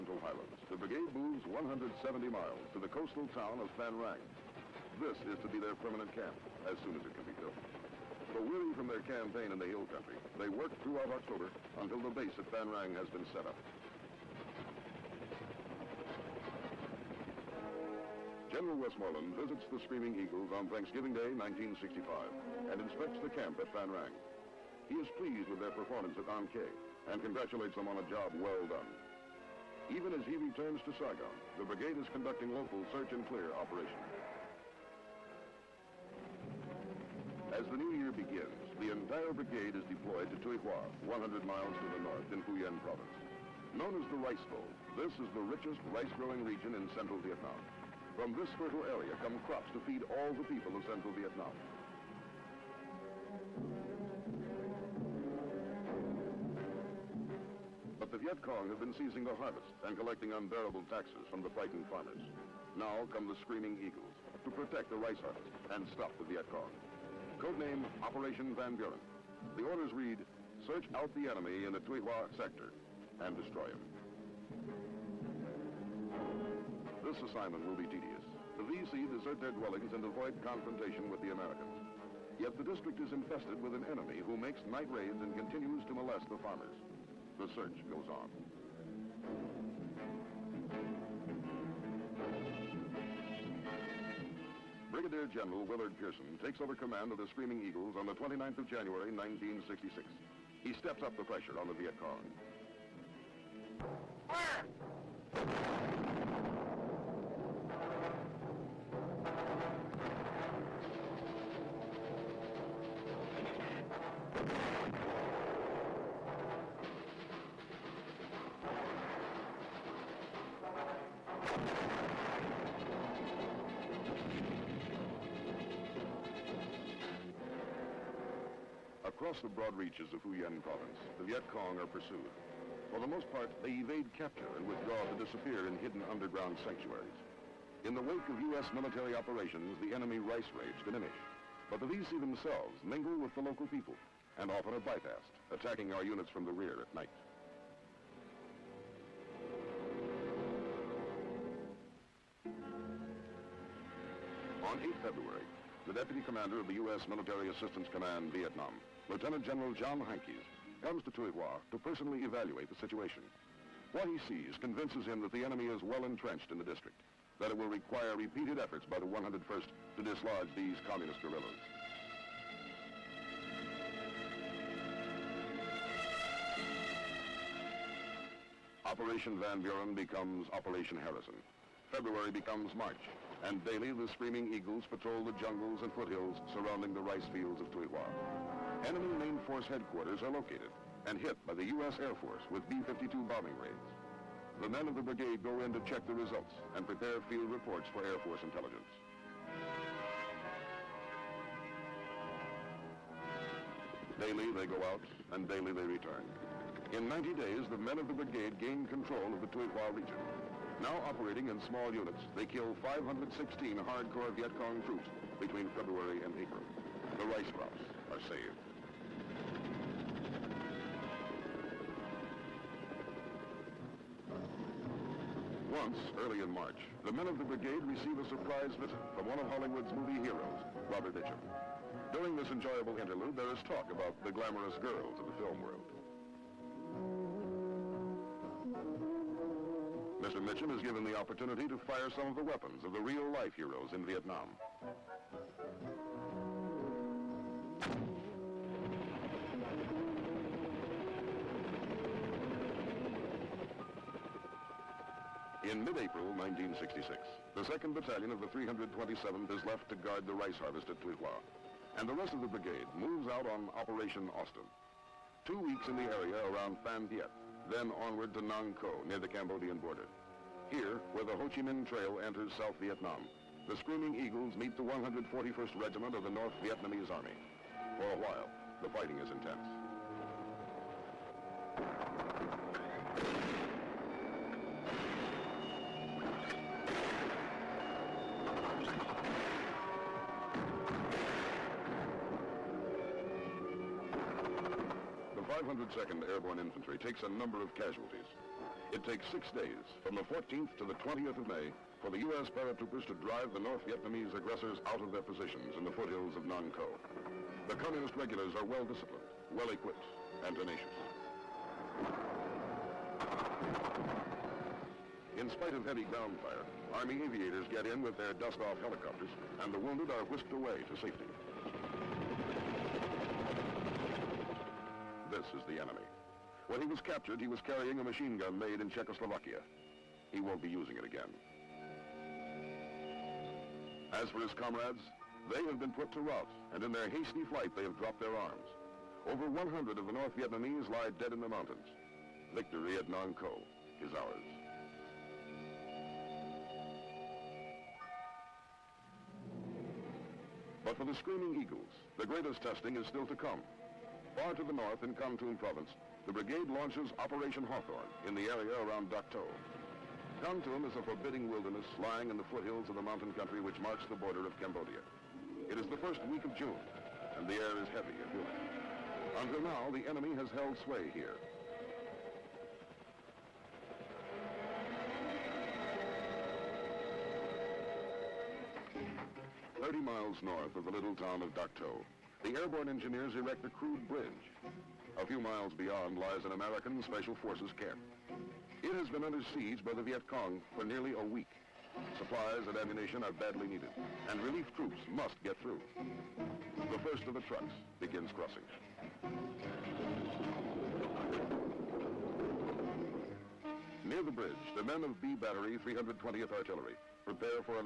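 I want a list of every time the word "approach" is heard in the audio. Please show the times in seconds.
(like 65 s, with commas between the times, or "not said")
not said.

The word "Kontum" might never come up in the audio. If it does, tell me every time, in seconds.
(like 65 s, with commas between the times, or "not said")
355 s, 360 s.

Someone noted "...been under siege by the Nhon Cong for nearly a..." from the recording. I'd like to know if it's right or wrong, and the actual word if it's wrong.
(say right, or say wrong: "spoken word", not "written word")
wrong: "Viet", not "Nhon".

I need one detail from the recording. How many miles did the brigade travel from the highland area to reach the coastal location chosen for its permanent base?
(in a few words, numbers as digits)
170.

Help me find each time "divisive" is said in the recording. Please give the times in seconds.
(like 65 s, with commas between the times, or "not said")
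not said.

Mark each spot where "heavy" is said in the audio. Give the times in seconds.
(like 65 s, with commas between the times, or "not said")
315 s, 367 s.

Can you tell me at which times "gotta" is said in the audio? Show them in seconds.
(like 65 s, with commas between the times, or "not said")
not said.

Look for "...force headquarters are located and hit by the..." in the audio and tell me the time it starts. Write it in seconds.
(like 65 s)
189 s.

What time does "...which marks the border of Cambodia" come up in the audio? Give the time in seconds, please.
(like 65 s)
363 s.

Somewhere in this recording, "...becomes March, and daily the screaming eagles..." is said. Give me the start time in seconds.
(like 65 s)
182 s.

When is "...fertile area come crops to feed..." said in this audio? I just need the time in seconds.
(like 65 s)
48 s.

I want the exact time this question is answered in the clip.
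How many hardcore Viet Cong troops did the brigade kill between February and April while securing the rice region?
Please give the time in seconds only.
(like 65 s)
212 s.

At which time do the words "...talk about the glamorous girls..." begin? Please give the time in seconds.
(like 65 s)
233 s.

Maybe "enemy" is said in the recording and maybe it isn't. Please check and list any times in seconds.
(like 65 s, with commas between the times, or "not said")
71 s, 83 s, 139 s, 165 s, 188 s, 325 s, 370 s.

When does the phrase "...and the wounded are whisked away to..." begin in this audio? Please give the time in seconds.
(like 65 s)
319 s.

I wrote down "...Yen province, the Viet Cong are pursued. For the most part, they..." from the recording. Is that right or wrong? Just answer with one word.
right.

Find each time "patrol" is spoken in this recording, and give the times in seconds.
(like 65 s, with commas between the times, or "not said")
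184 s.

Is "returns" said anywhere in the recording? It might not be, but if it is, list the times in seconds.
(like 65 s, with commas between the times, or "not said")
30 s, 205 s.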